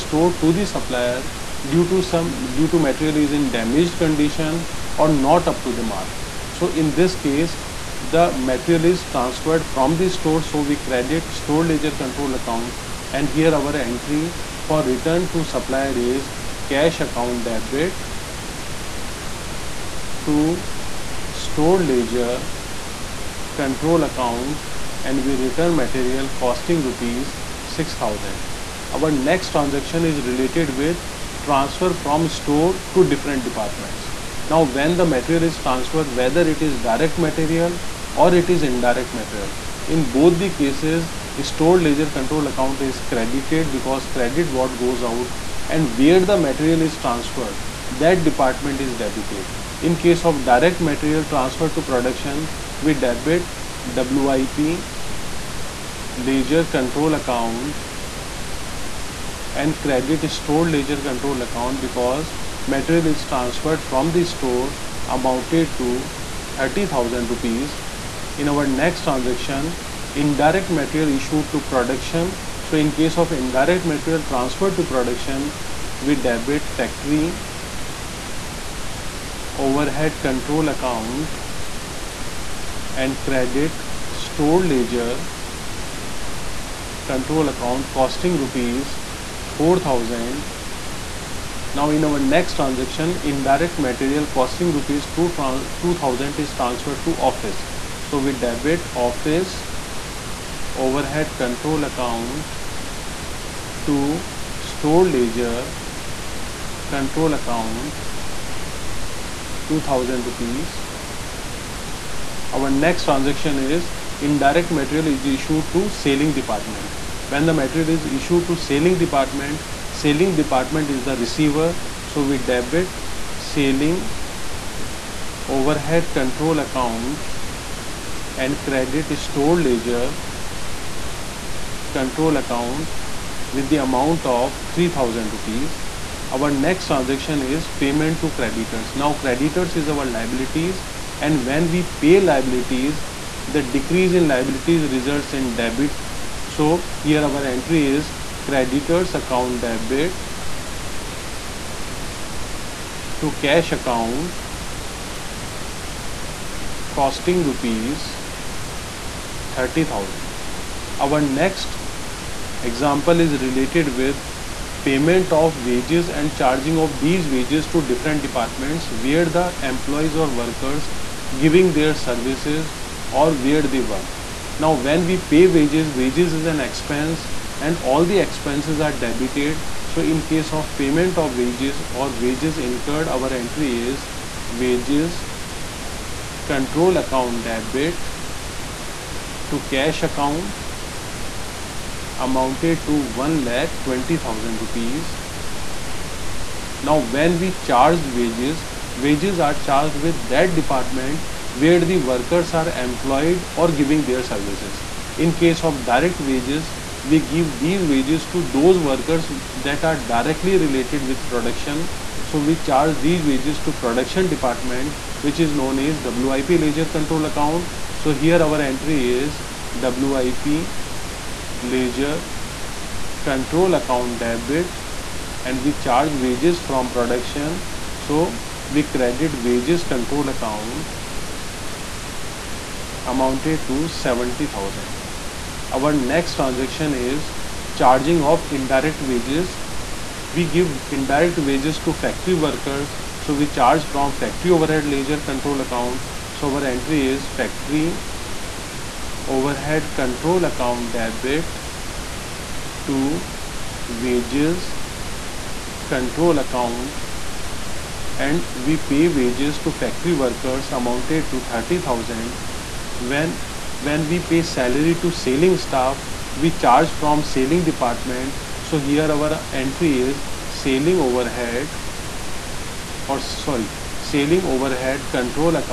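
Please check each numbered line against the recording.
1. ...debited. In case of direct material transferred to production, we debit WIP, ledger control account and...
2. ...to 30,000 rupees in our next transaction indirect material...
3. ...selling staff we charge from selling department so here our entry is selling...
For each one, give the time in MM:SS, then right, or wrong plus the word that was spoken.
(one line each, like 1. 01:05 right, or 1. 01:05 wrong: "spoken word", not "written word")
1. 00:48 right
2. 01:05 right
3. 04:25 right.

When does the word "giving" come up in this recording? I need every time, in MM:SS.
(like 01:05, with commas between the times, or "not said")
02:51, 03:23.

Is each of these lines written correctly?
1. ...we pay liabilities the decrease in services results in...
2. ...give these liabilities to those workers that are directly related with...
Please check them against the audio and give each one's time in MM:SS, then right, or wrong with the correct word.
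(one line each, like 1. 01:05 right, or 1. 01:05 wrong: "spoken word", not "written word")
1. 02:21 wrong: "liabilities", not "services"
2. 03:27 wrong: "wages", not "liabilities".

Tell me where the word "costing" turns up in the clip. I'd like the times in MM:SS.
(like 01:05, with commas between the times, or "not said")
00:26, 01:27, 01:34, 02:37.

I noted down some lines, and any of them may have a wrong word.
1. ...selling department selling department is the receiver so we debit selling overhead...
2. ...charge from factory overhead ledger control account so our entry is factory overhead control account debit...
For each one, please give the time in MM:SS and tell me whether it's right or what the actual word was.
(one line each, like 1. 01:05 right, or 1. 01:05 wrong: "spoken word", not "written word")
1. 01:58 right
2. 04:03 right.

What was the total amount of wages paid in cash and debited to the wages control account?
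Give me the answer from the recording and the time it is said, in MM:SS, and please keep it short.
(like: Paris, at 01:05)
120000 rupees, at 03:13.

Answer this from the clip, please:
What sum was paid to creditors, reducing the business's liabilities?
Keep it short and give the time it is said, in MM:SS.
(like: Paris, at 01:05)
30000 rupees, at 02:37.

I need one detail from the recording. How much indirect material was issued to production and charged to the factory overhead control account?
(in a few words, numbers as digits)
4000 rupees.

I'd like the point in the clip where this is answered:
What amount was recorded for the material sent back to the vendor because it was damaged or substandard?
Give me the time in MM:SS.
00:26.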